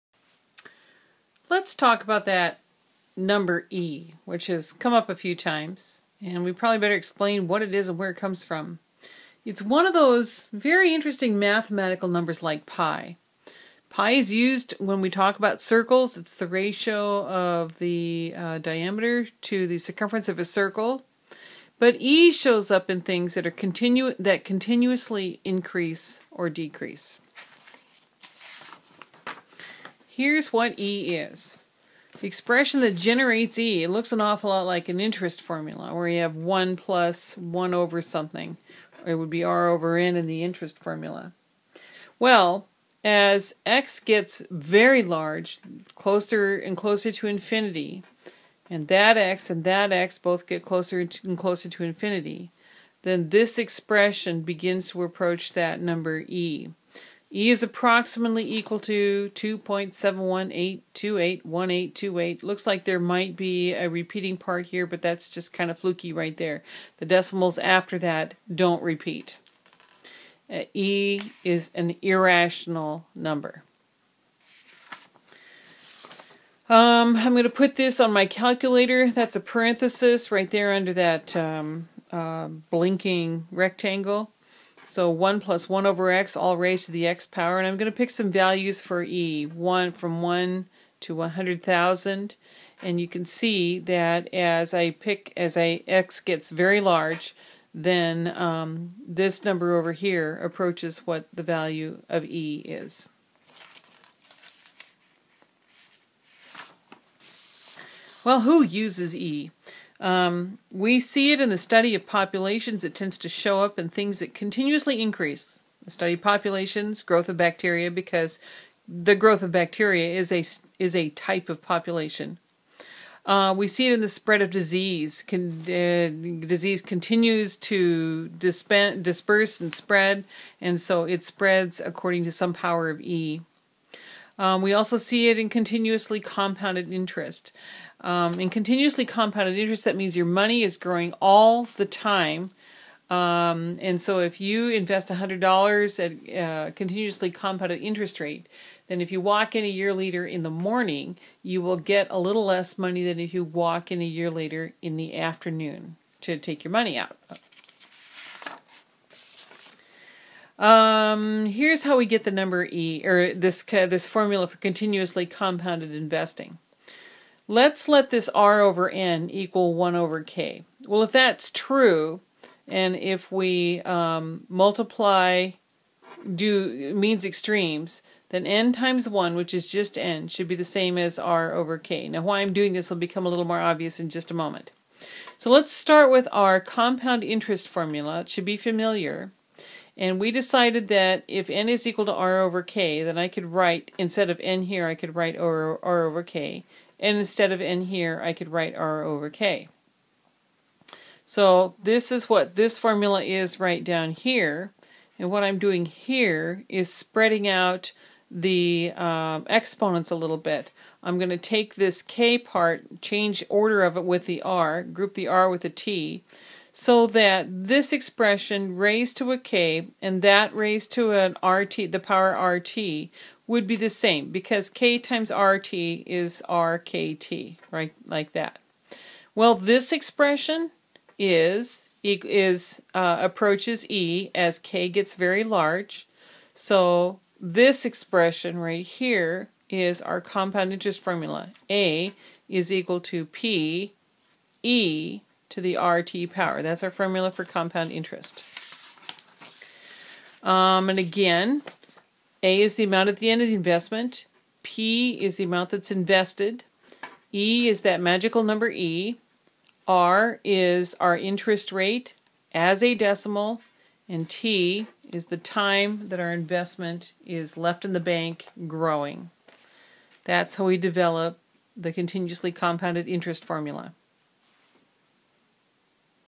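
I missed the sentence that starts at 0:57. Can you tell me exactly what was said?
E is approximately equal to 2.718281828.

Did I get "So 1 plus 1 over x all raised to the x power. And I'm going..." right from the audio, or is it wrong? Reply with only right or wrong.
right.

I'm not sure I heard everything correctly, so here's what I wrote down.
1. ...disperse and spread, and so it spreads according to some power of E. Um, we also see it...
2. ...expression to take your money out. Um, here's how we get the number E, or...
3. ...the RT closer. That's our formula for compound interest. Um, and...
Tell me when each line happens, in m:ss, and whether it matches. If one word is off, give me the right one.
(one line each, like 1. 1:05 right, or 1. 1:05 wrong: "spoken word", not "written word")
1. 2:08 right
2. 2:35 wrong: "afternoon", not "expression"
3. 4:05 wrong: "power", not "closer".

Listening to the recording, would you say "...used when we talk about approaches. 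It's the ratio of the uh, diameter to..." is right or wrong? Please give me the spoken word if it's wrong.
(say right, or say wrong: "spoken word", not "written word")
wrong: "circles", not "approaches".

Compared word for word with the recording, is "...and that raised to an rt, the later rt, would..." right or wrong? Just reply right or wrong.
wrong.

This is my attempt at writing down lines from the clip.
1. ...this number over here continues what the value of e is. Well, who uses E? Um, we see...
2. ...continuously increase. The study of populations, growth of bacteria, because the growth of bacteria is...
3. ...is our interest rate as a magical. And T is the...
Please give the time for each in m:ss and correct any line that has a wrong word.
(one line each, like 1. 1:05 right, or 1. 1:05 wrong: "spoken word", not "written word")
1. 1:39 wrong: "approaches", not "continues"
2. 1:54 right
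3. 4:20 wrong: "decimal", not "magical".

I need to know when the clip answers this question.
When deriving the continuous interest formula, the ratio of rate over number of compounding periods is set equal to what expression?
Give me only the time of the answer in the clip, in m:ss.
2:49.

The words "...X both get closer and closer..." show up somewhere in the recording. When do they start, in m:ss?
0:49.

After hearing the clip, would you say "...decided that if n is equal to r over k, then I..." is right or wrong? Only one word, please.
right.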